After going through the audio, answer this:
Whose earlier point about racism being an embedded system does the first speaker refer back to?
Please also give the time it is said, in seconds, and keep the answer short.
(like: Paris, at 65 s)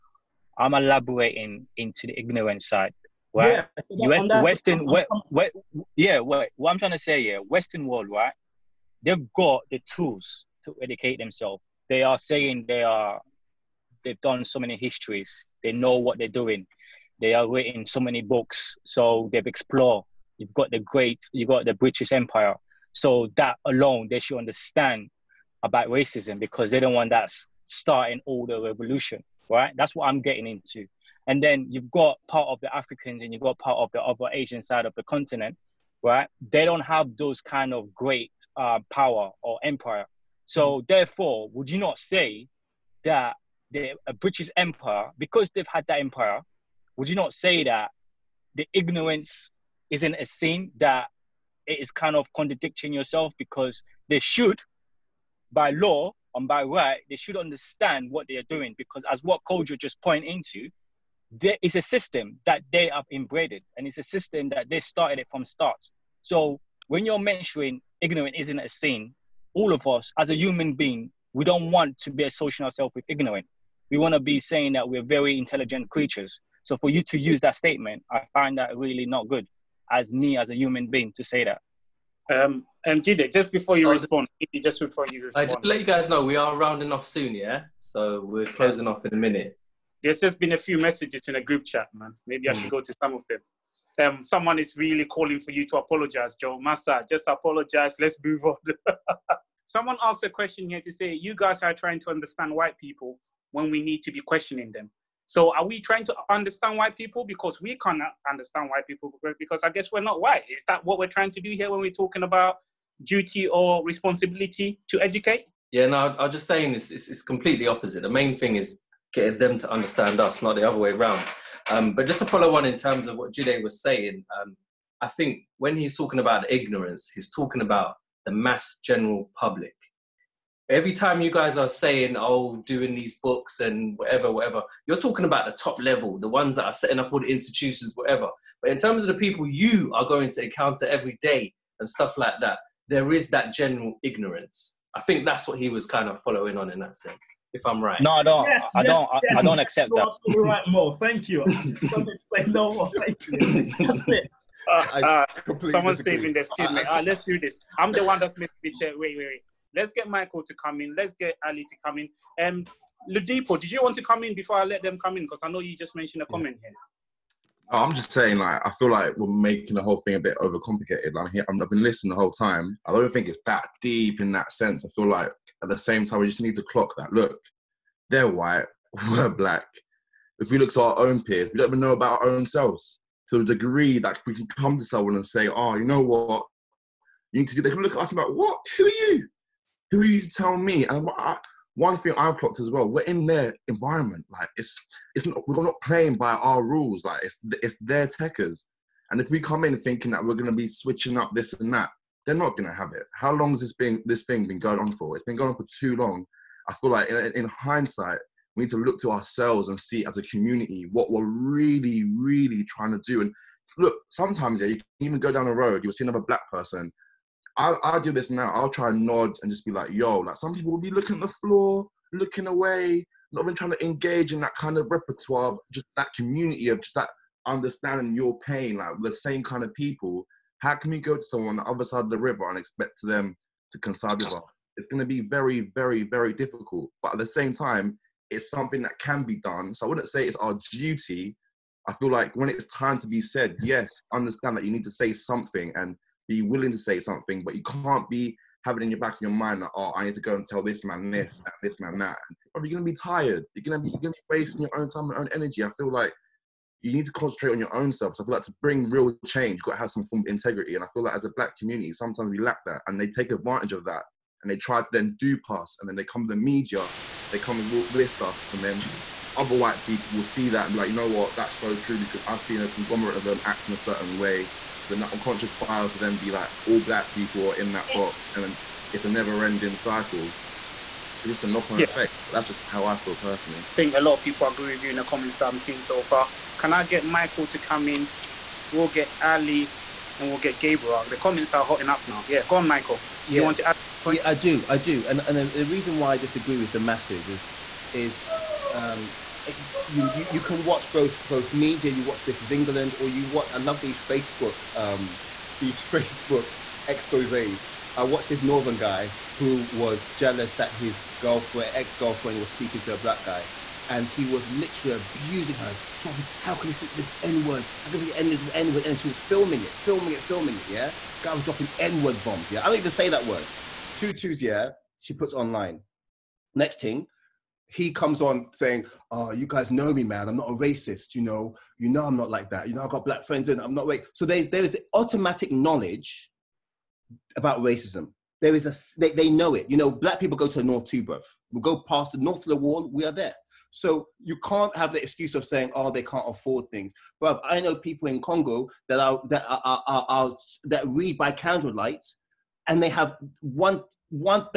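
Kojo, at 59 s.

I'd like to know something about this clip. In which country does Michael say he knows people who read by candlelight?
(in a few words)
Congo.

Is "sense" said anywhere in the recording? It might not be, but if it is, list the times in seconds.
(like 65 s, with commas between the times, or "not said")
146 s, 174 s.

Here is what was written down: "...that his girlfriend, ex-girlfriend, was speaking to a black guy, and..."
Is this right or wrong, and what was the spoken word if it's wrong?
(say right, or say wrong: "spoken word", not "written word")
right.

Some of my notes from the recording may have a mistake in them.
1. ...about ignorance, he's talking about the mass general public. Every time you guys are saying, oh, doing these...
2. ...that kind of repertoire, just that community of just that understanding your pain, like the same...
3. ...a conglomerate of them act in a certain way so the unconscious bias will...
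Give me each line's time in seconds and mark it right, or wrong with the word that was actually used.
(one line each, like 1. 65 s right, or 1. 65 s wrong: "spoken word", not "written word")
1. 126 s right
2. 224 s right
3. 272 s right.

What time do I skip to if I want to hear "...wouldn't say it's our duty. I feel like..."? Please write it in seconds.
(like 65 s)
239 s.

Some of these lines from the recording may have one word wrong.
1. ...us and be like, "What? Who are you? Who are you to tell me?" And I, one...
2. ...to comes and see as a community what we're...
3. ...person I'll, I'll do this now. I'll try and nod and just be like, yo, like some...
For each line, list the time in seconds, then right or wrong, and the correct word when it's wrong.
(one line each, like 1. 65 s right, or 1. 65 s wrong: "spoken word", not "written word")
1. 187 s right
2. 209 s wrong: "ourselves", not "comes"
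3. 216 s right.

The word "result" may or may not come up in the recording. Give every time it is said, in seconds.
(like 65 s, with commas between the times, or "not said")
not said.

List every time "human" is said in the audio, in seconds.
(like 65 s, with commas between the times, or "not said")
70 s, 80 s.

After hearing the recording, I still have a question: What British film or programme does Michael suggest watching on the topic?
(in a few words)
This Is England.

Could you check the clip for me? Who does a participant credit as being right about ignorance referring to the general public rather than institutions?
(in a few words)
Mo.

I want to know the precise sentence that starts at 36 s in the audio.
They don't have those kind of great uh, power or empire.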